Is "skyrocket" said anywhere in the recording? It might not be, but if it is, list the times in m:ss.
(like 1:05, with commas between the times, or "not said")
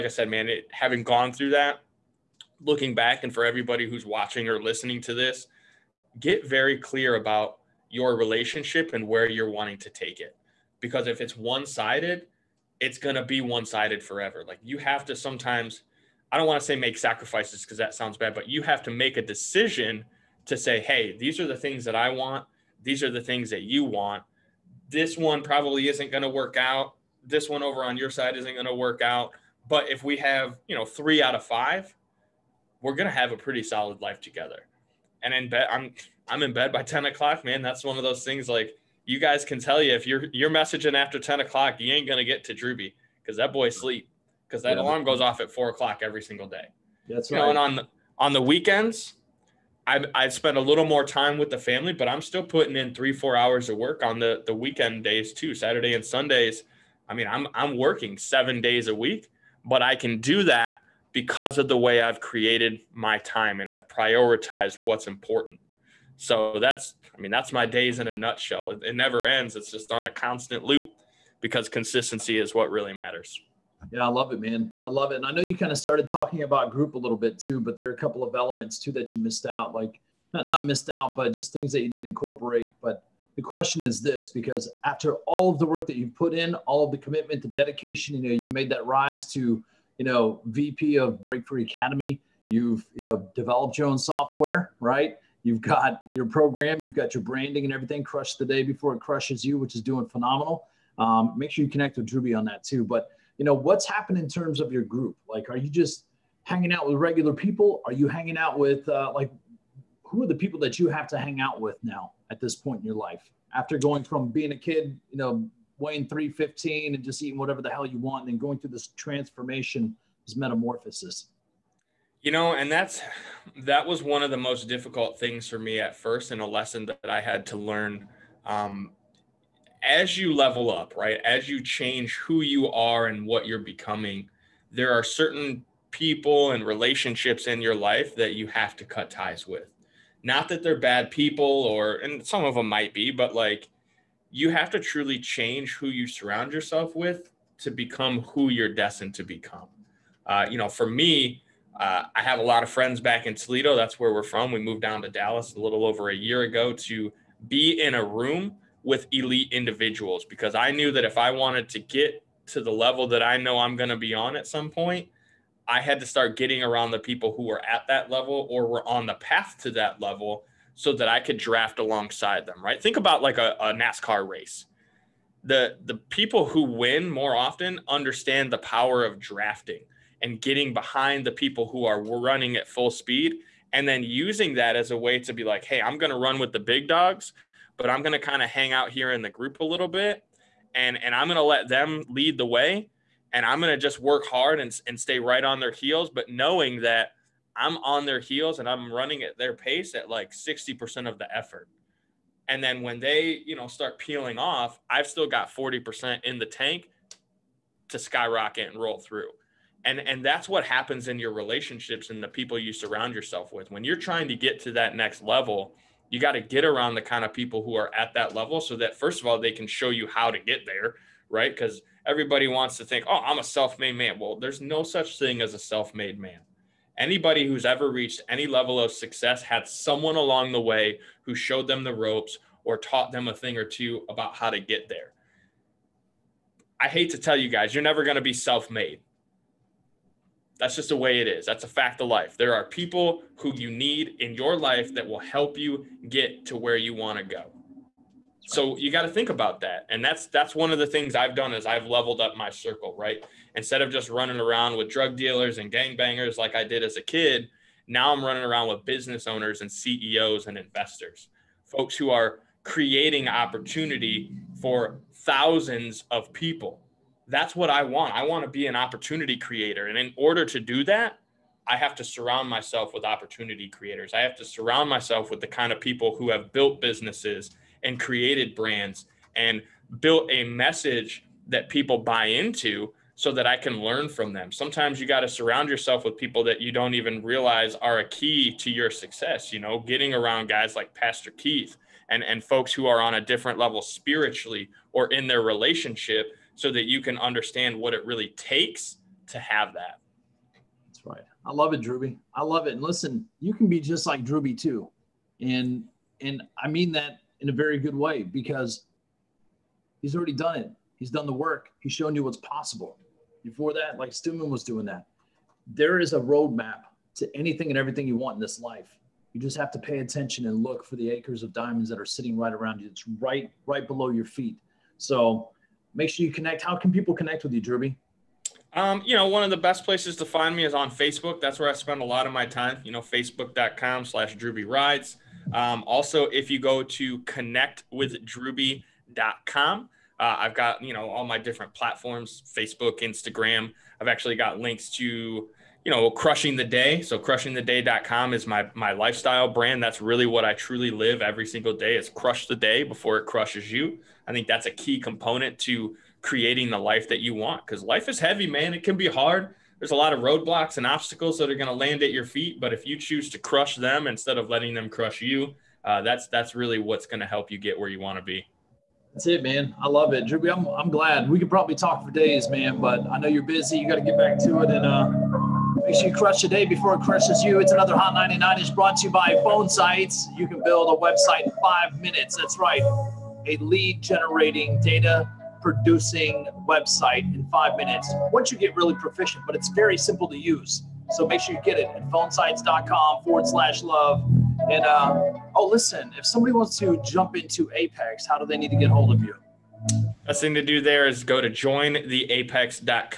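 3:27.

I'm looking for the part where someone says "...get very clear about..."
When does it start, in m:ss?
0:06.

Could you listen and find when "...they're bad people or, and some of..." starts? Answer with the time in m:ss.
2:20.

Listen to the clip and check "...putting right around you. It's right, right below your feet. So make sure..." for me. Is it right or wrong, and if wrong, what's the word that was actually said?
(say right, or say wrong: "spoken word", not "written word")
wrong: "sitting", not "putting".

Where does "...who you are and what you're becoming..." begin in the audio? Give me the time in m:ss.
2:12.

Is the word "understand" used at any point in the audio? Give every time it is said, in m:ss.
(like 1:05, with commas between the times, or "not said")
2:57, 4:57.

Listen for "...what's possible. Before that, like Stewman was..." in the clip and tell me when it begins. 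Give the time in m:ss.
5:12.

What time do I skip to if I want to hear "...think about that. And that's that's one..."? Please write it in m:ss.
4:09.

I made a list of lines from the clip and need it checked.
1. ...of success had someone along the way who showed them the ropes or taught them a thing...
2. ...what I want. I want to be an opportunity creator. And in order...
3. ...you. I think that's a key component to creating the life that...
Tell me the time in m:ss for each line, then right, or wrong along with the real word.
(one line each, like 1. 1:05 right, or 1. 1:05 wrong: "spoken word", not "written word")
1. 3:48 right
2. 4:27 right
3. 5:53 right.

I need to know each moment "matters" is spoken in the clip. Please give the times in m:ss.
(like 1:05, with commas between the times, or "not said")
1:12.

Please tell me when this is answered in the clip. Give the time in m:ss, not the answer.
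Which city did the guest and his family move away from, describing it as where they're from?
2:33.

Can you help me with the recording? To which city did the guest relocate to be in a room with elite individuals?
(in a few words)
Dallas.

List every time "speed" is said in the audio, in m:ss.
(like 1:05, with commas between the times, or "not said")
3:02.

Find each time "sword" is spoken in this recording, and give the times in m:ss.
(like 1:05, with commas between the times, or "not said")
not said.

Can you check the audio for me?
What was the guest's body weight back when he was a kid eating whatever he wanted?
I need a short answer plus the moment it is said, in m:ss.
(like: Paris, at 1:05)
315, at 1:56.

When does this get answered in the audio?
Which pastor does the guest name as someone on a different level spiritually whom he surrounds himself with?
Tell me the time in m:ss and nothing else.
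4:50.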